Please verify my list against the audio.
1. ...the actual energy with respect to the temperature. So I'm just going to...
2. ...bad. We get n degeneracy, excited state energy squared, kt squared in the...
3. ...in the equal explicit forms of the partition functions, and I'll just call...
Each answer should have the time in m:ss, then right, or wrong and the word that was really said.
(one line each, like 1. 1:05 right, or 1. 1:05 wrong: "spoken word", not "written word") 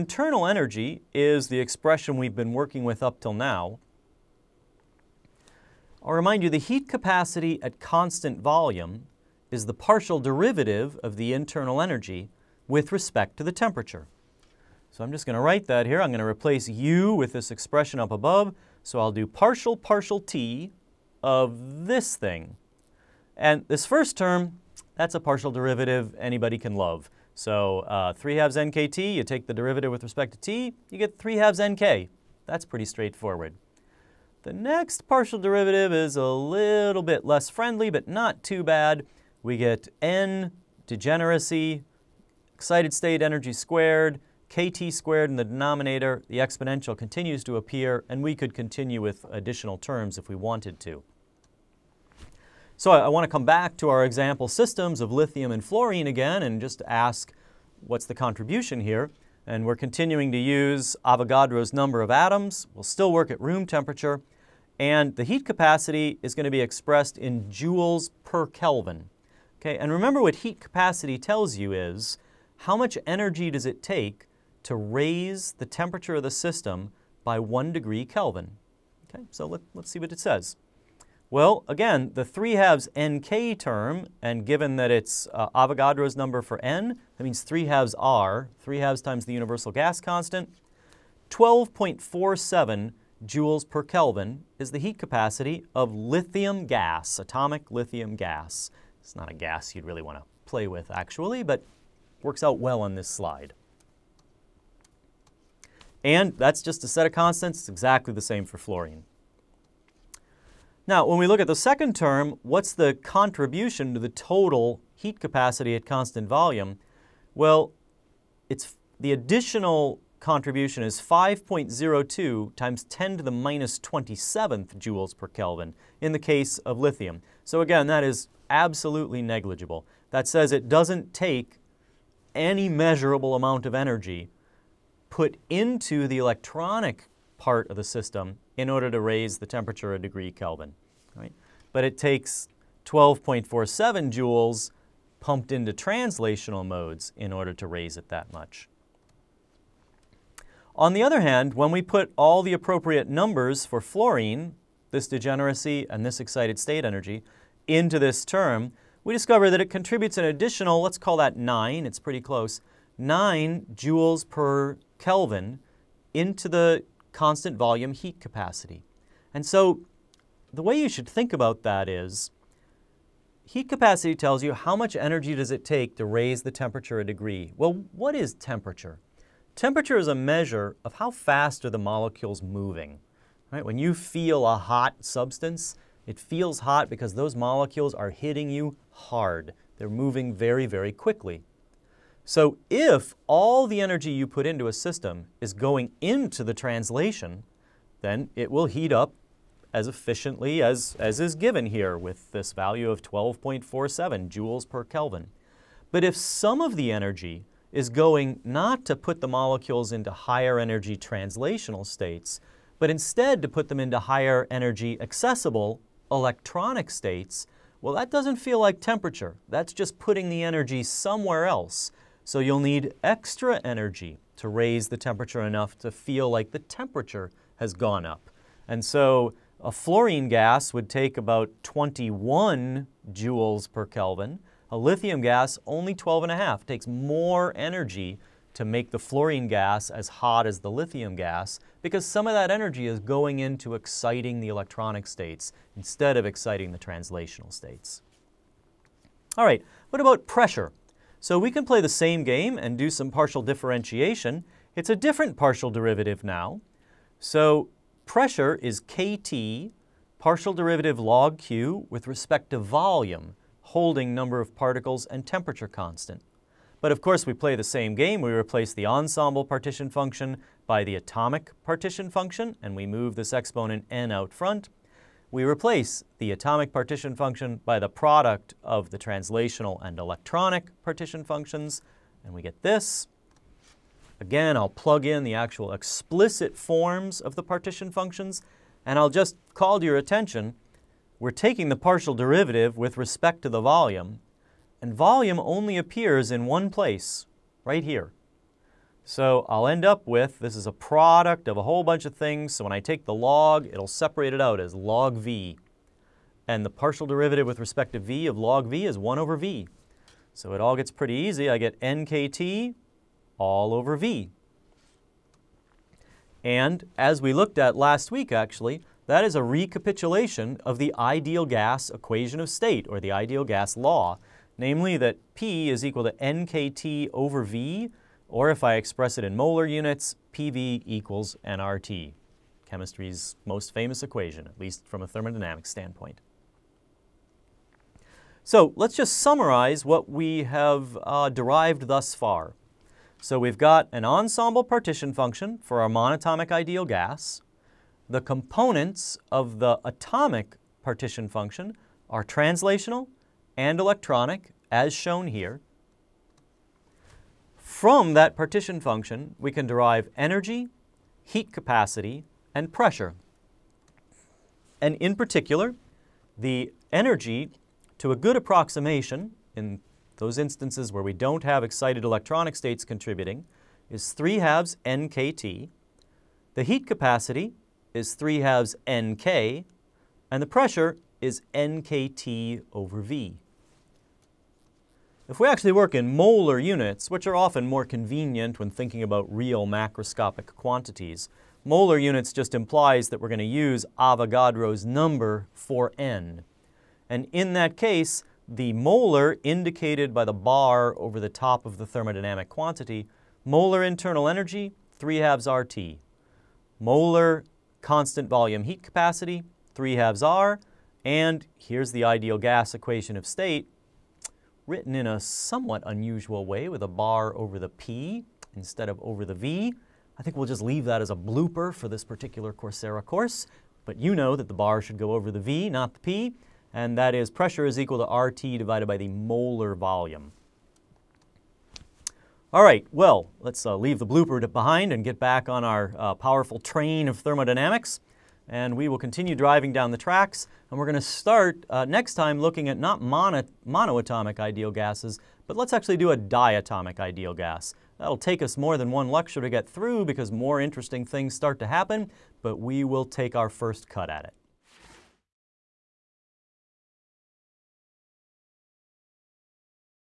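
1. 0:11 wrong: "internal", not "actual"
2. 0:38 right
3. 4:45 wrong: "actual", not "equal".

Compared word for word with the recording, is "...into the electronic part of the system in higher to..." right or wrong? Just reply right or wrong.
wrong.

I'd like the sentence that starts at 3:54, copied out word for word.
A lithium gas, only 12 and a half.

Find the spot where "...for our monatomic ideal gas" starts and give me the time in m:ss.
5:45.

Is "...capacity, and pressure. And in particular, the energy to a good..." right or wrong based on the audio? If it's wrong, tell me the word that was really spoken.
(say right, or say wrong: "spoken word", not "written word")
right.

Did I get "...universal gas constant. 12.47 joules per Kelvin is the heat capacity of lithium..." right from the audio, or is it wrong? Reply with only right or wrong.
right.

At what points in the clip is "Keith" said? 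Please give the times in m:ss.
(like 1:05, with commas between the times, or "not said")
not said.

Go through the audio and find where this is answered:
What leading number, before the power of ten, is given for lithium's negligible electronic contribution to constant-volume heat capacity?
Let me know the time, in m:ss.
2:01.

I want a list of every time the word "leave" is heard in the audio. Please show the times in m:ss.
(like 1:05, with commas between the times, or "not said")
7:00, 7:13.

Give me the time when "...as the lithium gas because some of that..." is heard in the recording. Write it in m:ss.
4:00.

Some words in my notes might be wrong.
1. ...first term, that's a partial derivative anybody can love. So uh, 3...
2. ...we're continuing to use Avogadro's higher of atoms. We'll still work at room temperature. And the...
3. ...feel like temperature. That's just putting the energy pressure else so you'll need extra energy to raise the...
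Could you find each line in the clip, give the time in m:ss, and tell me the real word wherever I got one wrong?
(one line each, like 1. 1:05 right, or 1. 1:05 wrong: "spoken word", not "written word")
1. 0:23 right
2. 0:59 wrong: "number", not "higher"
3. 3:38 wrong: "somewhere", not "pressure".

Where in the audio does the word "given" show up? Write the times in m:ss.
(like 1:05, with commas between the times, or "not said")
1:24, 3:21.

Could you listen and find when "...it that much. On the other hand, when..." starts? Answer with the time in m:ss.
2:27.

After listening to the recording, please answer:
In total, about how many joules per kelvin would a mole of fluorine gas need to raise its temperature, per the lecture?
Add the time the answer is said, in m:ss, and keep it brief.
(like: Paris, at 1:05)
21, at 3:51.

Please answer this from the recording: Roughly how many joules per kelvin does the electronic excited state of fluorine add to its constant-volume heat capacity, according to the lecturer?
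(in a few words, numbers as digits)
9.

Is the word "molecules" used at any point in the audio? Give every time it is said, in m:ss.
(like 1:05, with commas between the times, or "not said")
3:01, 3:07, 3:29.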